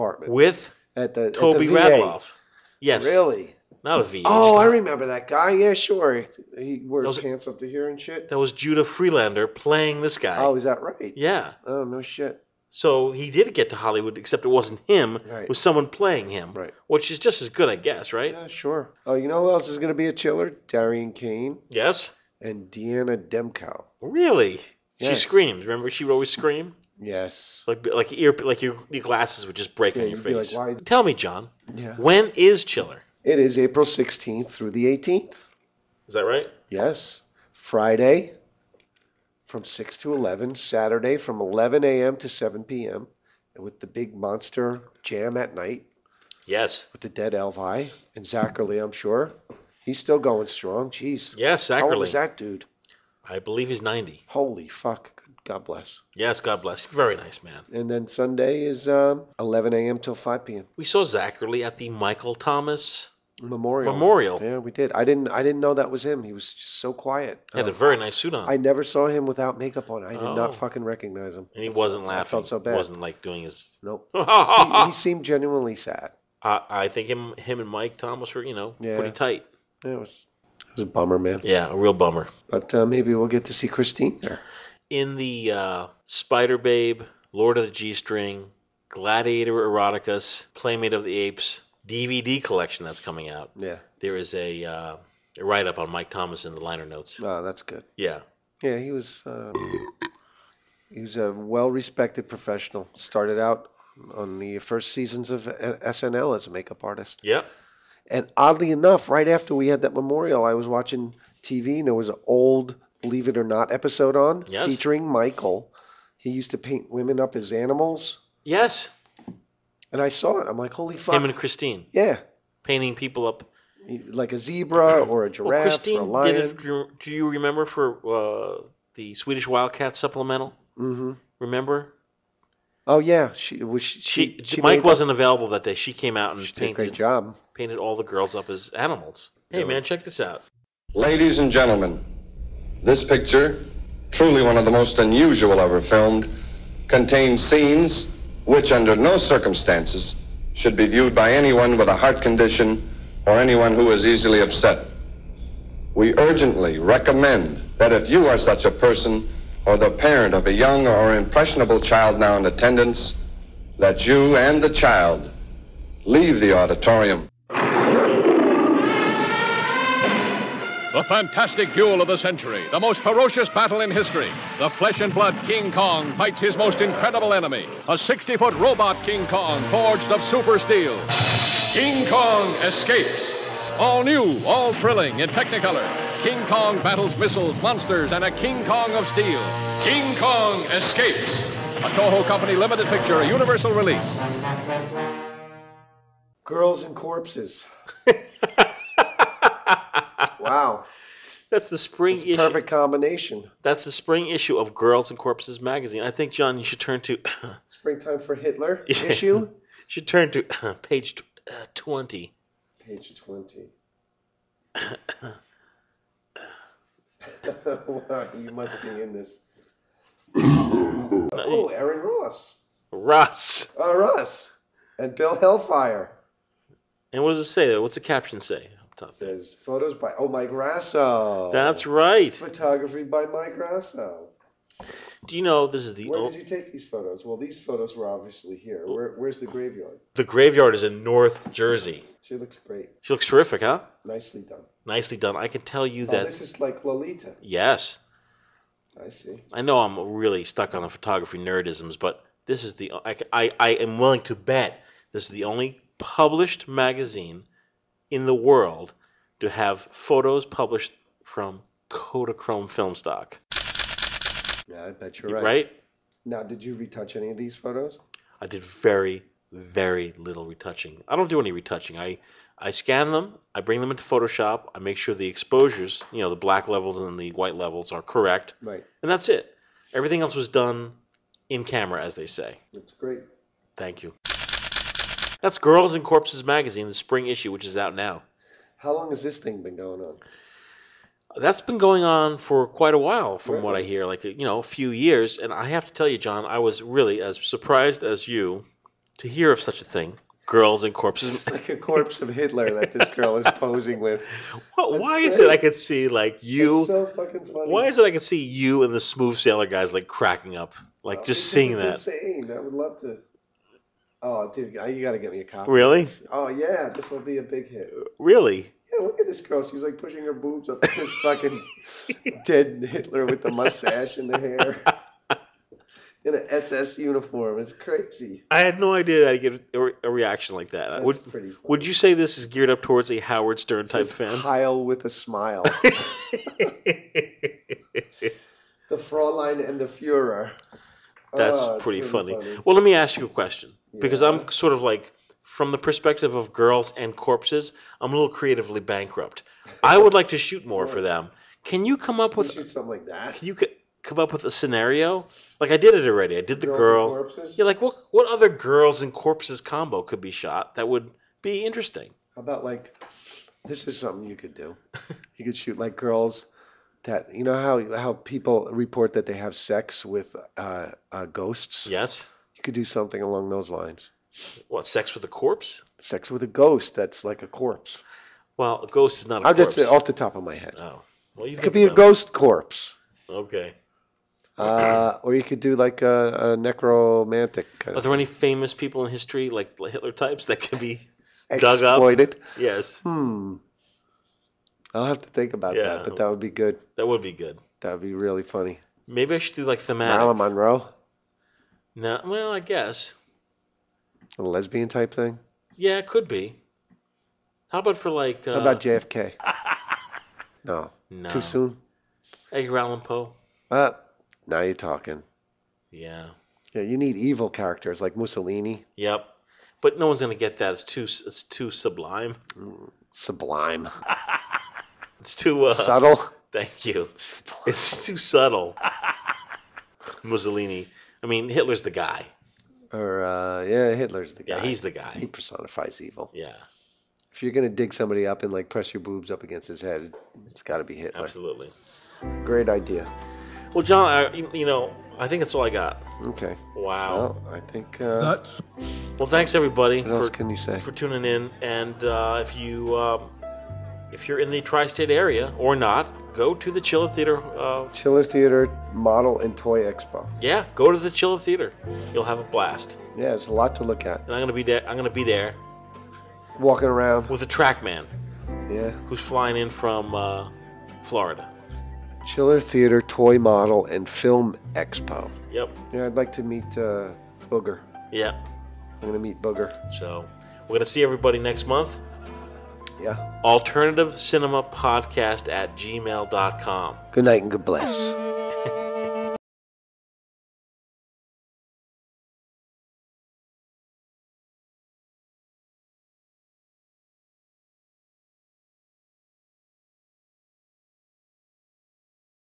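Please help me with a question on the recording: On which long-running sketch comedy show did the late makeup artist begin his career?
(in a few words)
SNL.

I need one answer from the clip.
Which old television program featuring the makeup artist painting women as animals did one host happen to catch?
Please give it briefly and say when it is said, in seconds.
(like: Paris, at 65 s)
Believe It or Not, at 113 s.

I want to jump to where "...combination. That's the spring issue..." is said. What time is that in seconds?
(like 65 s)
202 s.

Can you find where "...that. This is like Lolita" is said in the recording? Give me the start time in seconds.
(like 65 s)
246 s.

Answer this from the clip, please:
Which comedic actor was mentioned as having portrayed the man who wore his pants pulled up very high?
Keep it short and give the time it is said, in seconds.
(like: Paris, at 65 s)
Judah Friedlander, at 8 s.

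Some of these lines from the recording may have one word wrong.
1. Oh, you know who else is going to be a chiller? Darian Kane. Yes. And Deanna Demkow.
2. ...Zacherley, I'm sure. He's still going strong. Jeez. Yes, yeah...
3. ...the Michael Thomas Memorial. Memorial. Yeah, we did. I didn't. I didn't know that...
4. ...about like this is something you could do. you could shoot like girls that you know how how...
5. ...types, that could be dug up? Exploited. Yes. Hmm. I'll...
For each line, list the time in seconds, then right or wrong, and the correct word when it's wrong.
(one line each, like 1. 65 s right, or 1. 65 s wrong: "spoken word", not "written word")
1. 19 s right
2. 48 s right
3. 61 s right
4. 362 s right
5. 390 s right.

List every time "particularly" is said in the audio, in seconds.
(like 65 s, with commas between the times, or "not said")
not said.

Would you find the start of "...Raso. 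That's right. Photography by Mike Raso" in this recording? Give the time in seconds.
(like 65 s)
230 s.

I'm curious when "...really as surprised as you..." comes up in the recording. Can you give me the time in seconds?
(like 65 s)
296 s.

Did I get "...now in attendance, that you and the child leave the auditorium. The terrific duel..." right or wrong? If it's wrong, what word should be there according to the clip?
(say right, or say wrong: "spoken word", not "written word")
wrong: "fantastic", not "terrific".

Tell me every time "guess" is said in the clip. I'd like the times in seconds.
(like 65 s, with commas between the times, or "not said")
17 s, 402 s.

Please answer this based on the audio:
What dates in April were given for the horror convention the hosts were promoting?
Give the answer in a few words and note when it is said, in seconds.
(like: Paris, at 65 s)
April 16th through the 18th, at 33 s.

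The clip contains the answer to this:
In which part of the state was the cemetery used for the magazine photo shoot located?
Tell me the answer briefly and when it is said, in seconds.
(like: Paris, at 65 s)
North Jersey, at 241 s.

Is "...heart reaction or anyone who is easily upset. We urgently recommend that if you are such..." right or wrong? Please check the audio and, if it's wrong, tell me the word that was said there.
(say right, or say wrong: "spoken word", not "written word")
wrong: "condition", not "reaction".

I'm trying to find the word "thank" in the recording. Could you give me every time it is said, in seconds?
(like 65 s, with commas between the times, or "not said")
283 s, 426 s, 449 s.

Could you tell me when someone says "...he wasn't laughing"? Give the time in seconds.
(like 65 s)
71 s.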